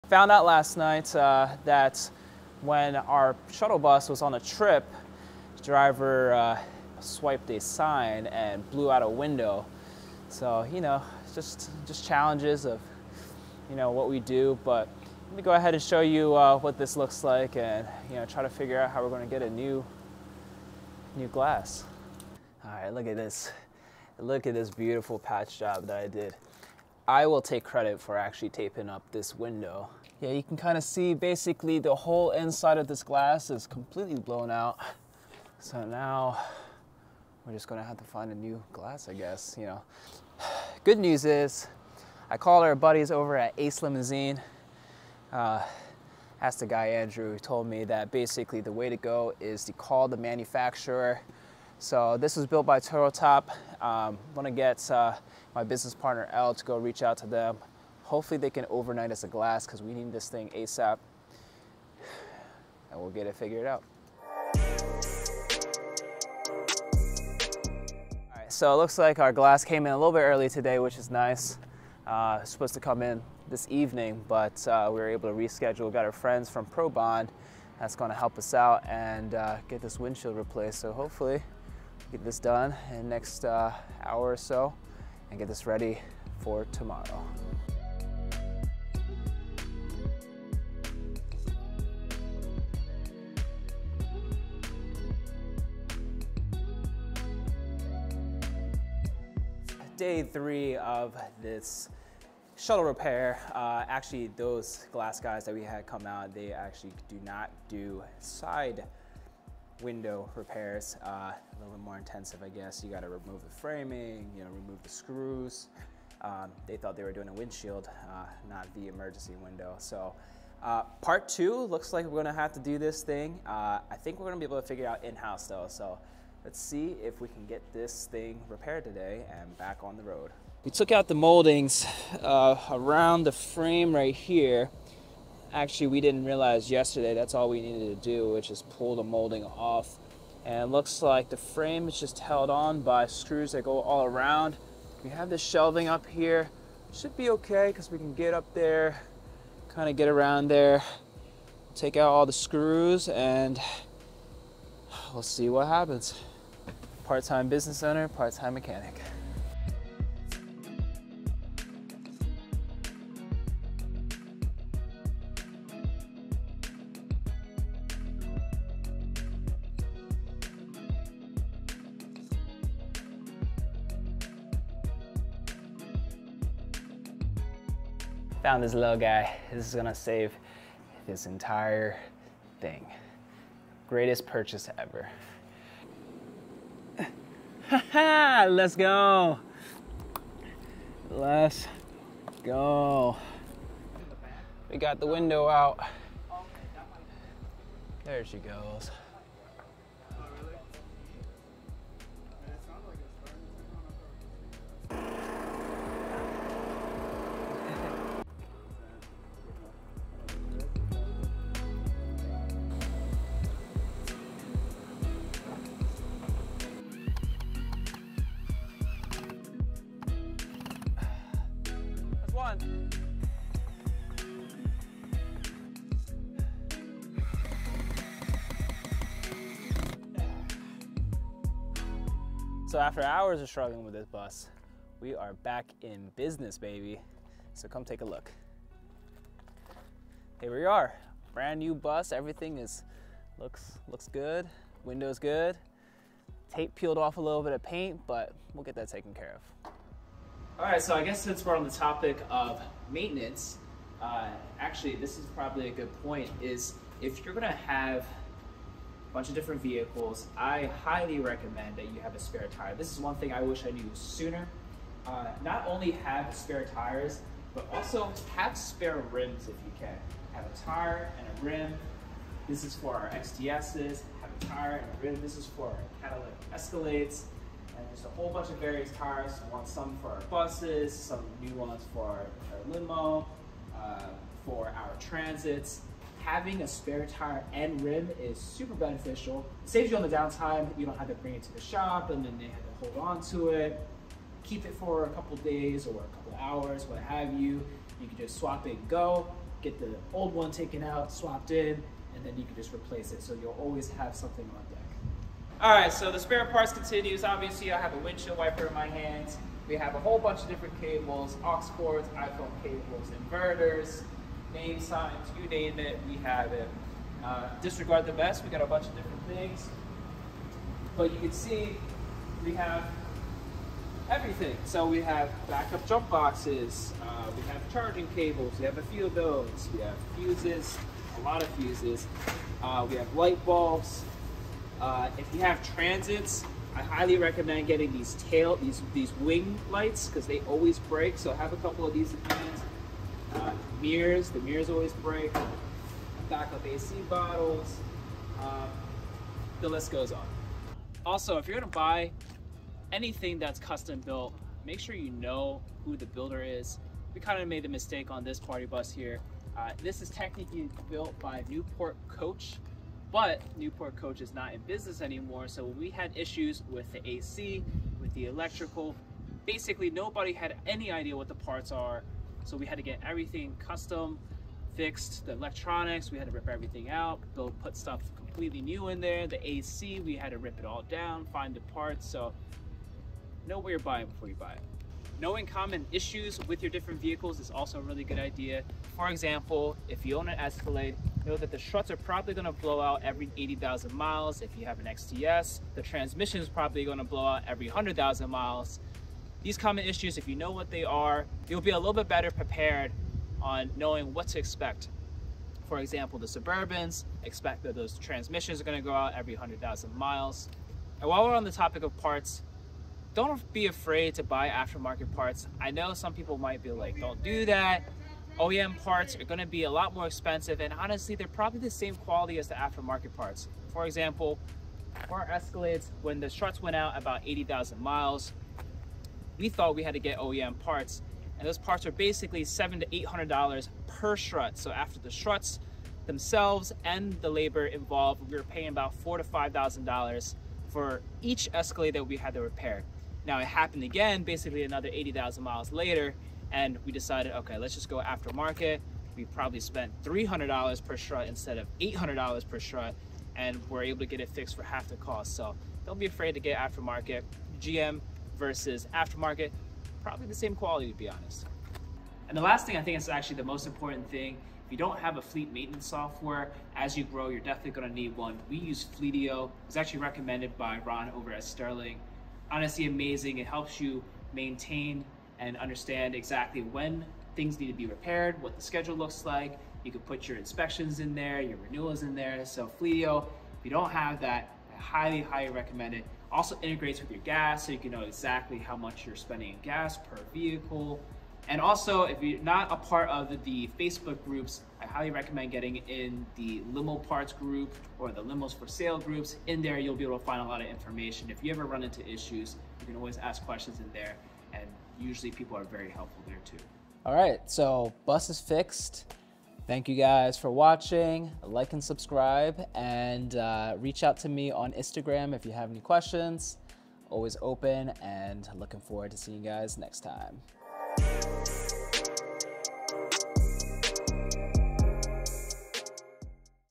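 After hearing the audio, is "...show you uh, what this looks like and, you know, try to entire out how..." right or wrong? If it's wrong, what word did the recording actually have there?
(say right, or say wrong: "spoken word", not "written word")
wrong: "figure", not "entire".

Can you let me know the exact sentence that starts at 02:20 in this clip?
And looks like the frame is just held on by screws that go all around.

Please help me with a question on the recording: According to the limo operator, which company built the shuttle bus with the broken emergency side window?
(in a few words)
Turtletop.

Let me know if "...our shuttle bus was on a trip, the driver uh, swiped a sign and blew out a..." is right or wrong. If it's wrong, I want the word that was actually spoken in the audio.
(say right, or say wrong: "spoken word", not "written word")
right.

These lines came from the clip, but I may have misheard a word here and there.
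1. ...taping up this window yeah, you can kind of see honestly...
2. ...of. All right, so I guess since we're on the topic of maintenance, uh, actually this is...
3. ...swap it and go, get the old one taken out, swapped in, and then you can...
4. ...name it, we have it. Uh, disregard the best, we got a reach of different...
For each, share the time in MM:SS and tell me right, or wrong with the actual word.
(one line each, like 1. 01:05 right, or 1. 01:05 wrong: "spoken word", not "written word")
1. 00:28 wrong: "basically", not "honestly"
2. 04:09 right
3. 04:58 right
4. 05:15 wrong: "bunch", not "reach".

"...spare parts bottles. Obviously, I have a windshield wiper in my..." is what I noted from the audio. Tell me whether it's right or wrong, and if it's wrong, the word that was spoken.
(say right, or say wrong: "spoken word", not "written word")
wrong: "continues", not "bottles".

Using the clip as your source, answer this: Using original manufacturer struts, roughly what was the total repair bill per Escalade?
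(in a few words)
$4,000 to $5,000.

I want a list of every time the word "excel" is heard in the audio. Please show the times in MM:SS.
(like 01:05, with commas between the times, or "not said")
not said.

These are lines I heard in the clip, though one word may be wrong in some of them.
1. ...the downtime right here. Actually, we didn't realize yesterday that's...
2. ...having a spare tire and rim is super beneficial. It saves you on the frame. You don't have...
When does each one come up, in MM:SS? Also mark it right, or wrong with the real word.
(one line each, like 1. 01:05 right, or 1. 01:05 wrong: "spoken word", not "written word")
1. 02:13 wrong: "frame", not "downtime"
2. 04:46 wrong: "downtime", not "frame".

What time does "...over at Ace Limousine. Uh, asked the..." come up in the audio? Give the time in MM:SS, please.
00:43.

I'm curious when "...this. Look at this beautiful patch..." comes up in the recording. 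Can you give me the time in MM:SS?
00:23.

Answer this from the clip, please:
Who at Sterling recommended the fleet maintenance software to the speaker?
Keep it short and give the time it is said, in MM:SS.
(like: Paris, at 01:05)
Ron, at 07:50.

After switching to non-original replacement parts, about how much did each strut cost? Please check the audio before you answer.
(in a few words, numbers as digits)
$300.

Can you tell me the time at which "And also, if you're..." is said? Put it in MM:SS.
08:11.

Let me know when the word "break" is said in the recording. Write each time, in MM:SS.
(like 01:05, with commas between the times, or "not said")
05:40, 05:44.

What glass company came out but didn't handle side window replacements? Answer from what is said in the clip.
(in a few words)
ProBond.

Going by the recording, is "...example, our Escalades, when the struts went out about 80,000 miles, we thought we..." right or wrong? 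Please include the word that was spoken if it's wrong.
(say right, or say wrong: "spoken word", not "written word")
right.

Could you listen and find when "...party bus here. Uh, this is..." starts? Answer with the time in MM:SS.
05:58.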